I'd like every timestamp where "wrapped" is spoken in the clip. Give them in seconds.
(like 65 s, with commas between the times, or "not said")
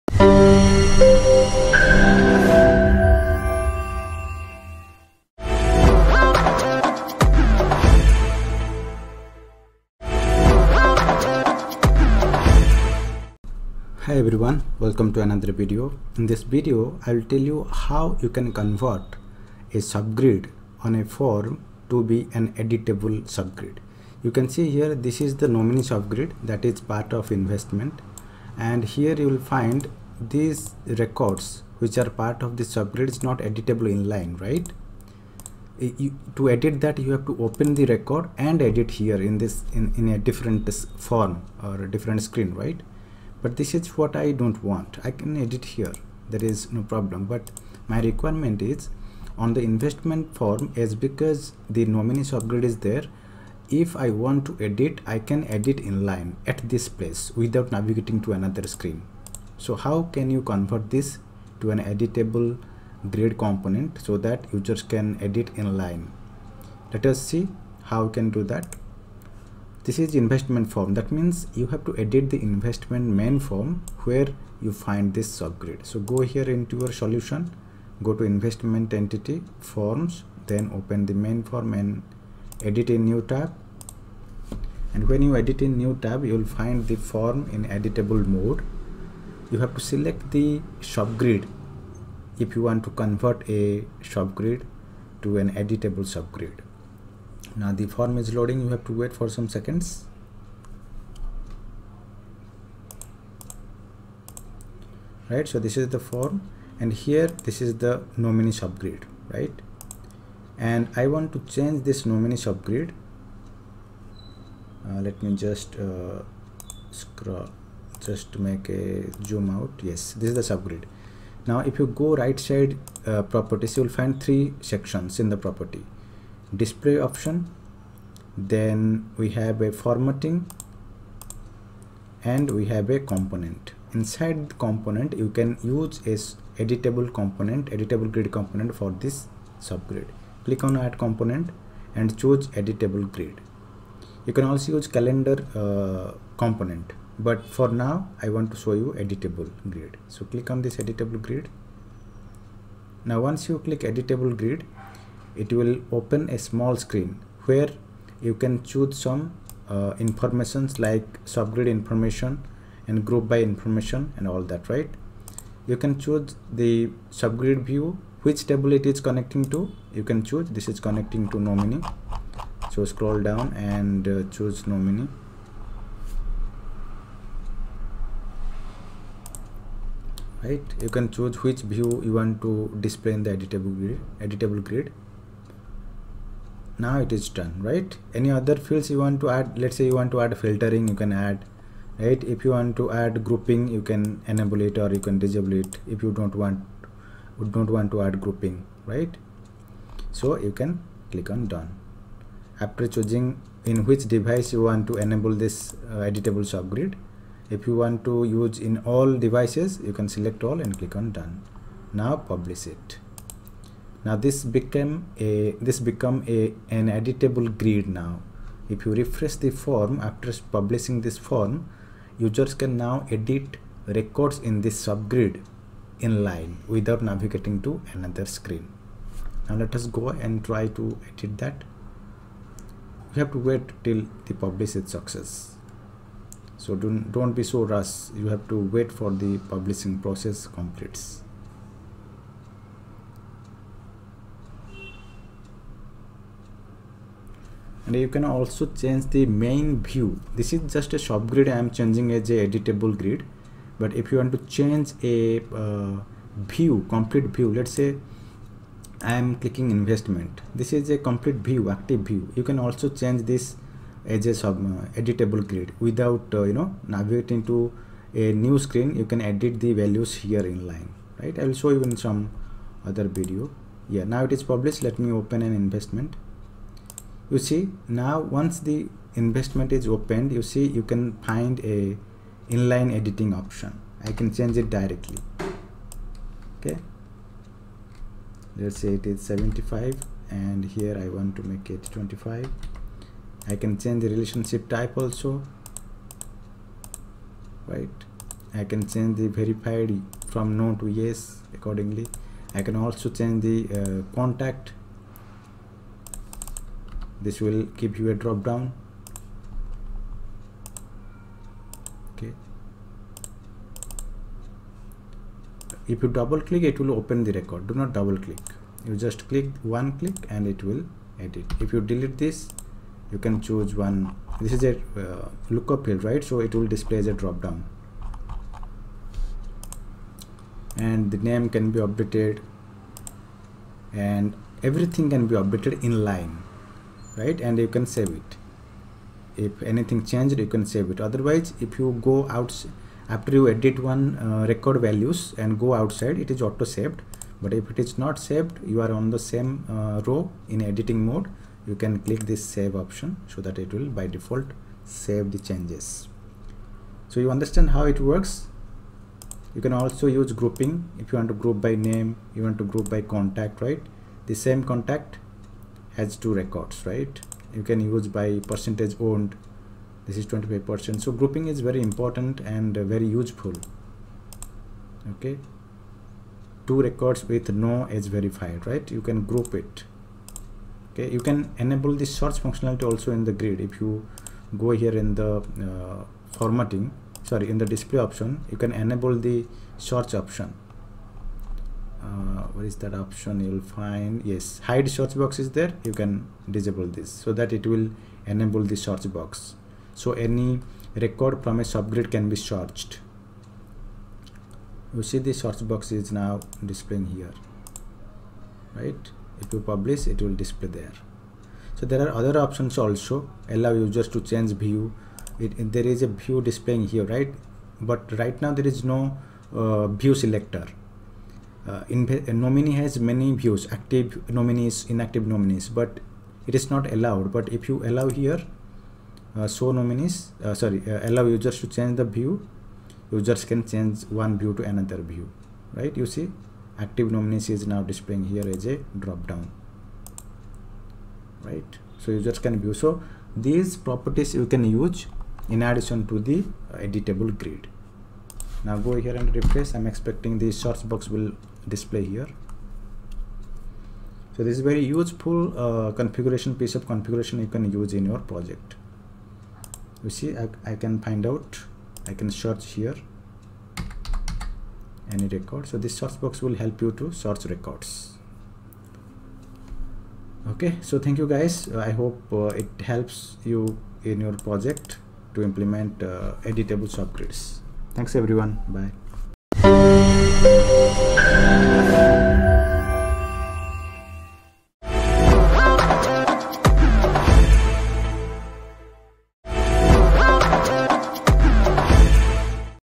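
not said.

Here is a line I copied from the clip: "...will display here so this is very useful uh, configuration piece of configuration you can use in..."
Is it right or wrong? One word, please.
right.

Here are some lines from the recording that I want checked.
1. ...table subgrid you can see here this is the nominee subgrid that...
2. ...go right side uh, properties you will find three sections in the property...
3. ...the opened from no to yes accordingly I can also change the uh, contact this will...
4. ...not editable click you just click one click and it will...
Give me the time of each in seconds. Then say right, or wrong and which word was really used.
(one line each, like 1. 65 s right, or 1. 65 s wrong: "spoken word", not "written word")
1. 22 s wrong: "editable", not "table"
2. 121 s right
3. 299 s wrong: "verified", not "opened"
4. 317 s wrong: "double", not "editable".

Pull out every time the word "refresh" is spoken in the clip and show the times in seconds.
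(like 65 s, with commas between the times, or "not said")
218 s, 449 s.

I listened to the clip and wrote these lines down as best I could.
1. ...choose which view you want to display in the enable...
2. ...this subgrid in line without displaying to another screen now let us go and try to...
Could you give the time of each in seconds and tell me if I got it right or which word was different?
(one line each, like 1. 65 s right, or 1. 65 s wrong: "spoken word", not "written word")
1. 181 s wrong: "editable", not "enable"
2. 224 s wrong: "navigating", not "displaying".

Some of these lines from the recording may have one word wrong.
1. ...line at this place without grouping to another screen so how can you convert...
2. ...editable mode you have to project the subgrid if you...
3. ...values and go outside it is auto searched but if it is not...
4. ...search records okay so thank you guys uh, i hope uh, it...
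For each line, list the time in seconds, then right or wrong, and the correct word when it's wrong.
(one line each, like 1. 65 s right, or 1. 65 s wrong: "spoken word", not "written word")
1. 56 s wrong: "navigating", not "grouping"
2. 87 s wrong: "select", not "project"
3. 344 s wrong: "saved", not "searched"
4. 467 s right.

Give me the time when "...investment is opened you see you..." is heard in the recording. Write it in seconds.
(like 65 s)
279 s.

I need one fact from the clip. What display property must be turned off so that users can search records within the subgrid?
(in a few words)
hide search box.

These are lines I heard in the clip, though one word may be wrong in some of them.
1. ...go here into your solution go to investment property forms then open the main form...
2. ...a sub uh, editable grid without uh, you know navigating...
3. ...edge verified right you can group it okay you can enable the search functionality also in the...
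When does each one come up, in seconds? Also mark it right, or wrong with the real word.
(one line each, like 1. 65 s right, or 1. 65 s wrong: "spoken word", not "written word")
1. 76 s wrong: "entity", not "property"
2. 264 s right
3. 377 s right.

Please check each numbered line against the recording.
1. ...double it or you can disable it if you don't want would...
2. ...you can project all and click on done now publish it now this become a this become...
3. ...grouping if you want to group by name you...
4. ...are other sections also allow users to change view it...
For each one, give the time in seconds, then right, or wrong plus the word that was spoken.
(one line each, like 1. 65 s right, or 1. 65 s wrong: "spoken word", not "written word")
1. 194 s wrong: "enable", not "double"
2. 209 s wrong: "select", not "project"
3. 360 s right
4. 412 s wrong: "options", not "sections".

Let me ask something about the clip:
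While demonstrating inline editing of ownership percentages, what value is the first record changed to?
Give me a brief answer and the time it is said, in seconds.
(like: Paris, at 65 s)
75, at 289 s.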